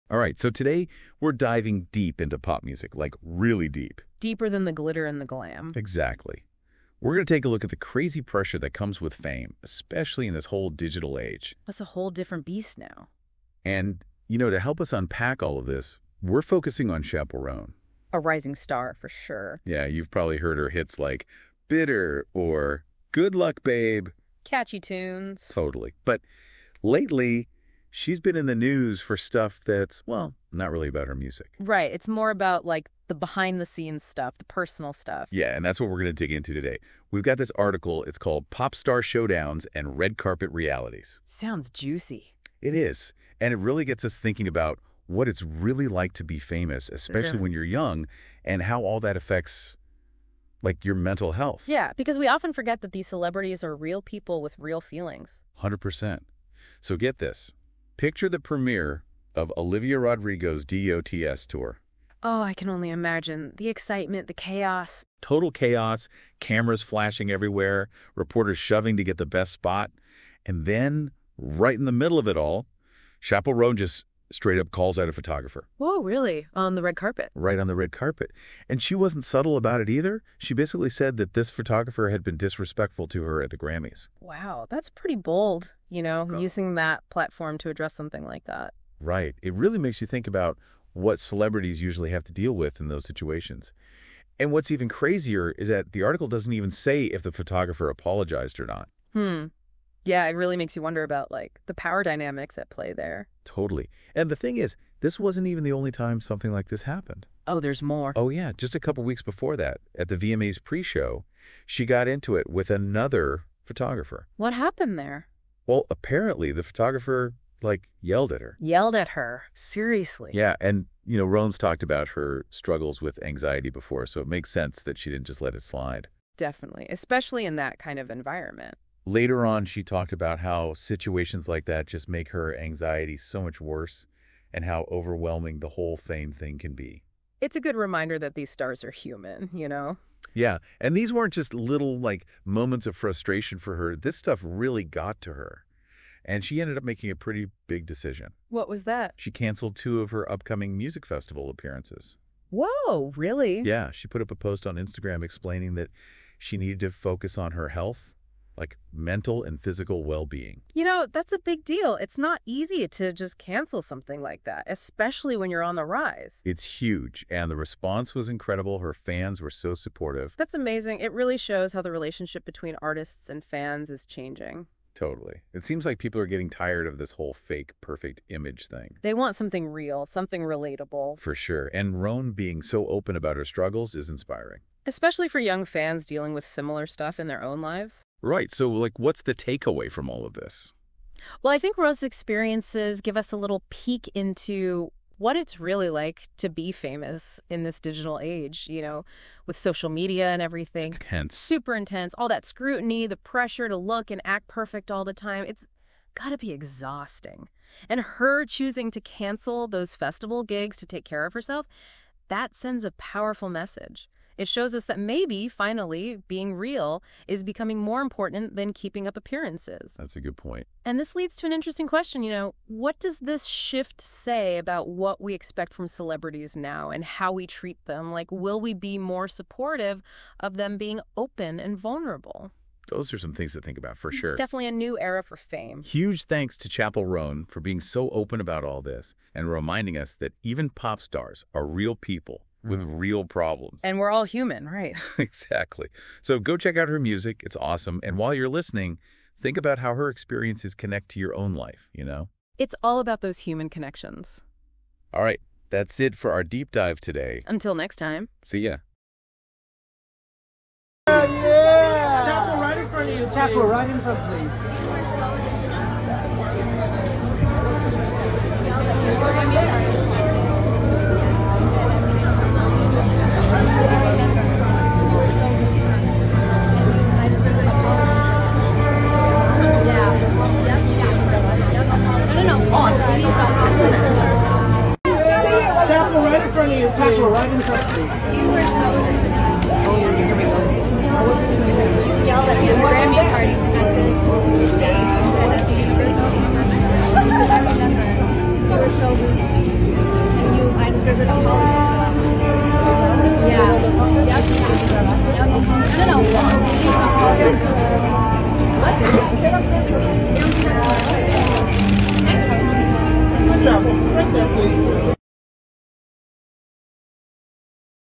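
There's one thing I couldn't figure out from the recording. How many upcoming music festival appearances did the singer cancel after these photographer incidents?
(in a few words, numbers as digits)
2.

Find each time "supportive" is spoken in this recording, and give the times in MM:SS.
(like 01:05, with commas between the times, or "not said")
02:49, 03:49.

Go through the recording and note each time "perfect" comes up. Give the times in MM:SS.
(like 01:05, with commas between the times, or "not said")
02:57, 03:24.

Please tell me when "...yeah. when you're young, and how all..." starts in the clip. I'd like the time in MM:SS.
00:47.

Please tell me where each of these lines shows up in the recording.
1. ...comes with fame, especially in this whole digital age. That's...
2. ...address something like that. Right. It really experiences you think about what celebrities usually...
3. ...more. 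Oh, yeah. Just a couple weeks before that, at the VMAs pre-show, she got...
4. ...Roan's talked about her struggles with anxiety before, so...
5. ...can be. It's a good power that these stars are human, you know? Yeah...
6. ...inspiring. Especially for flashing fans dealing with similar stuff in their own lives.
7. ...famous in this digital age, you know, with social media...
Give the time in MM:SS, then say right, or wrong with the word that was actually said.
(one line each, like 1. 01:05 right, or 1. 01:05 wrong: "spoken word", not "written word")
1. 00:08 right
2. 01:27 wrong: "makes", not "experiences"
3. 01:47 right
4. 02:01 right
5. 02:16 wrong: "reminder", not "power"
6. 03:04 wrong: "young", not "flashing"
7. 03:16 right.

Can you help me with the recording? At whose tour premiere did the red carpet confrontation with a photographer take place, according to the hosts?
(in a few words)
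Olivia Rodrigo.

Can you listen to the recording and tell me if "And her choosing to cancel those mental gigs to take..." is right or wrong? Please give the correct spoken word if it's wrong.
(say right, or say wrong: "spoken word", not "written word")
wrong: "festival", not "mental".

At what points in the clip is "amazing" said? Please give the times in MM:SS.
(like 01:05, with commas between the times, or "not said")
02:50.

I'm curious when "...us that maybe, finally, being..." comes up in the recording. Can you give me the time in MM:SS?
03:34.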